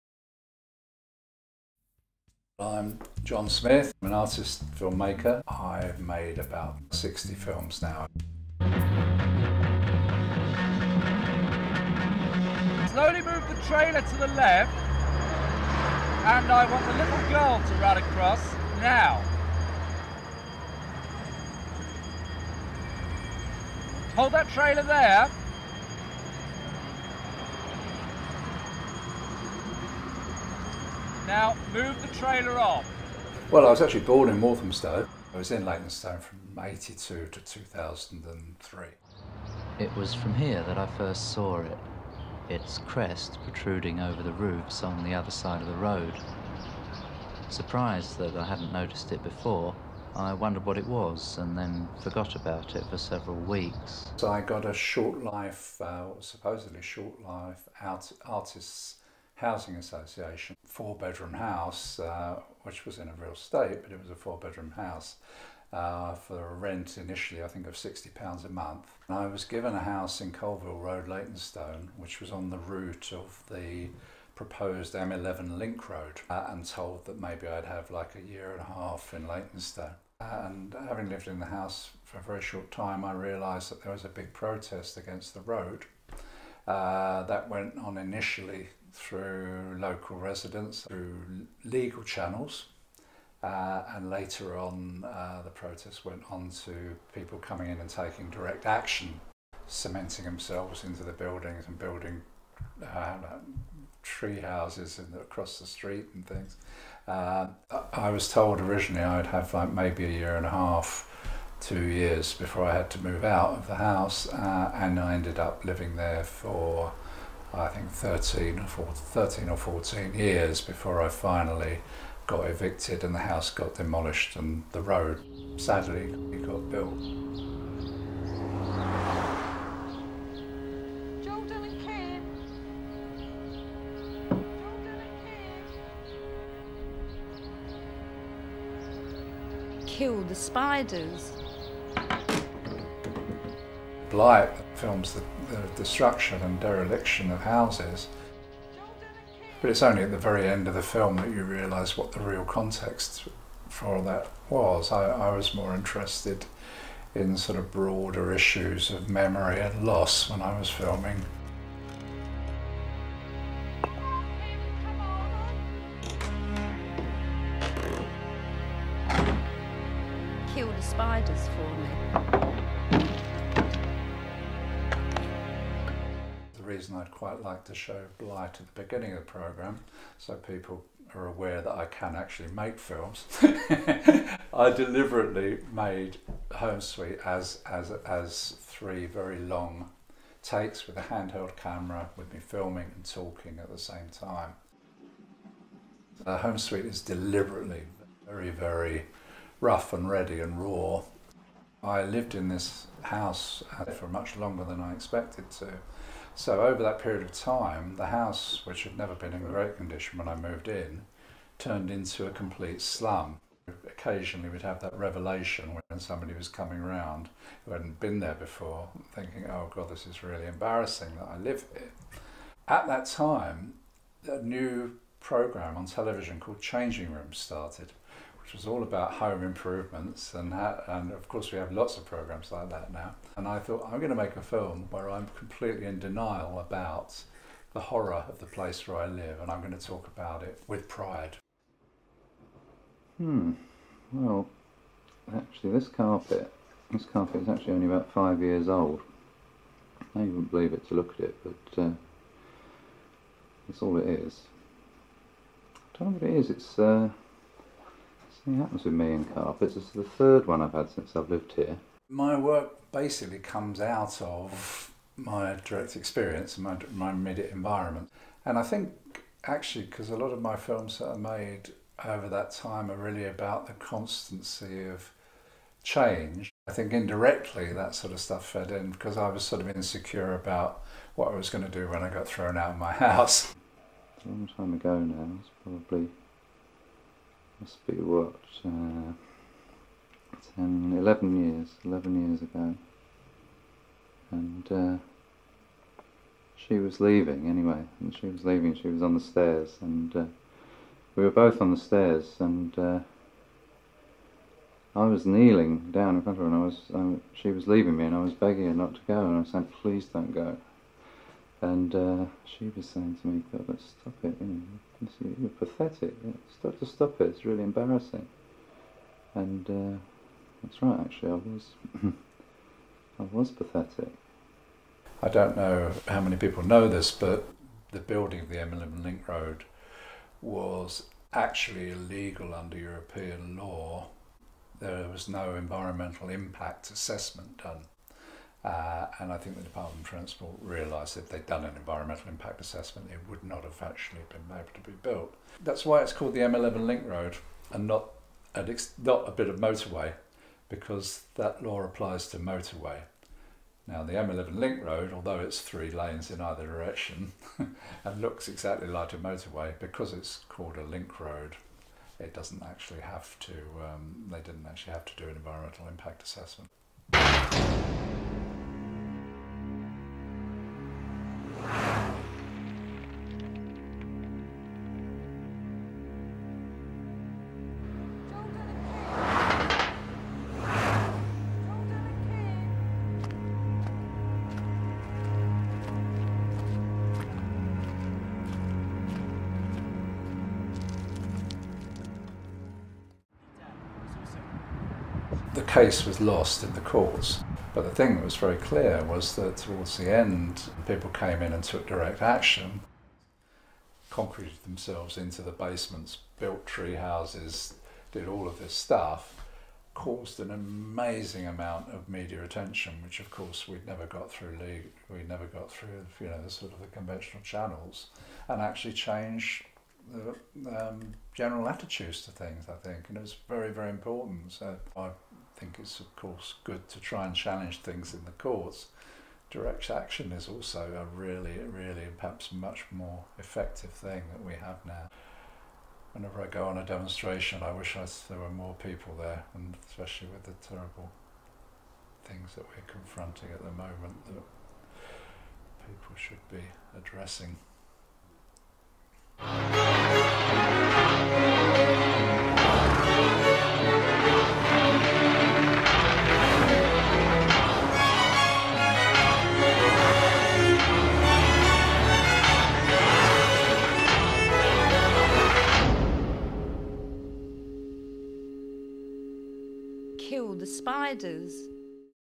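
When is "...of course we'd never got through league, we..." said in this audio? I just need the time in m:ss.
6:53.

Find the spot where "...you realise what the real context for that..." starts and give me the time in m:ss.
2:31.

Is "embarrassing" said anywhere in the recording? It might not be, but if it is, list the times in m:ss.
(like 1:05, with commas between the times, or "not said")
3:40, 5:17.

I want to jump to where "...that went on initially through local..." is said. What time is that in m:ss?
1:27.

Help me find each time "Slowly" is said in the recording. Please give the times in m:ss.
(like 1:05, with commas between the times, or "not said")
0:12.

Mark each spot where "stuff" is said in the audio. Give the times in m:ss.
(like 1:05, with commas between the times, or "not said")
4:38, 6:48.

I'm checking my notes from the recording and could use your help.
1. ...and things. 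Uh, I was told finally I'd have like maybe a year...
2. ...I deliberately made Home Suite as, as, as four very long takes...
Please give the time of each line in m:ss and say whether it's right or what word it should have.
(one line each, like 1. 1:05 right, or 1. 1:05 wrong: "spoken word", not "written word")
1. 1:46 wrong: "originally", not "finally"
2. 3:04 wrong: "three", not "four".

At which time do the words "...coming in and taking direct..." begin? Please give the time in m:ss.
1:37.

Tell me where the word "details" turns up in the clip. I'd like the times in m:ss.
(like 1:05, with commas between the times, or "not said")
not said.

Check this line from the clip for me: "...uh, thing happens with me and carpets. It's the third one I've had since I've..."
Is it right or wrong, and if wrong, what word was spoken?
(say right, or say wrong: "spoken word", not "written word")
right.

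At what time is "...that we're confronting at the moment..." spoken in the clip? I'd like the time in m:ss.
7:22.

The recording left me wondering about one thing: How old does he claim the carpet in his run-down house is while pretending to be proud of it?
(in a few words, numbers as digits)
5 years.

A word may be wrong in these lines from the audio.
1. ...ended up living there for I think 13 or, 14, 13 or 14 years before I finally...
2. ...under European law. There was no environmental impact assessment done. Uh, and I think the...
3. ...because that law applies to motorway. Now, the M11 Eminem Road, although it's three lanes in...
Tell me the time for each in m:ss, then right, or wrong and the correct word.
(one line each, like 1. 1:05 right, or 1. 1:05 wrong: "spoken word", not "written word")
1. 1:55 right
2. 5:32 right
3. 5:50 wrong: "Link", not "Eminem".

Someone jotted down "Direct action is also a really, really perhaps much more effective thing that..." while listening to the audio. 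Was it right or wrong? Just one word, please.
right.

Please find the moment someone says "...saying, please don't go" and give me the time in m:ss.
5:09.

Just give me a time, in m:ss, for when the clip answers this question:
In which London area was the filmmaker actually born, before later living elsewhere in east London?
0:34.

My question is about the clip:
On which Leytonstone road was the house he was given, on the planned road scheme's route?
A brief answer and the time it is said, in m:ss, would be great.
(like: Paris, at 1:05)
Colville Road, at 1:10.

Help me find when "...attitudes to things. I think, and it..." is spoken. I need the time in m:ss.
7:01.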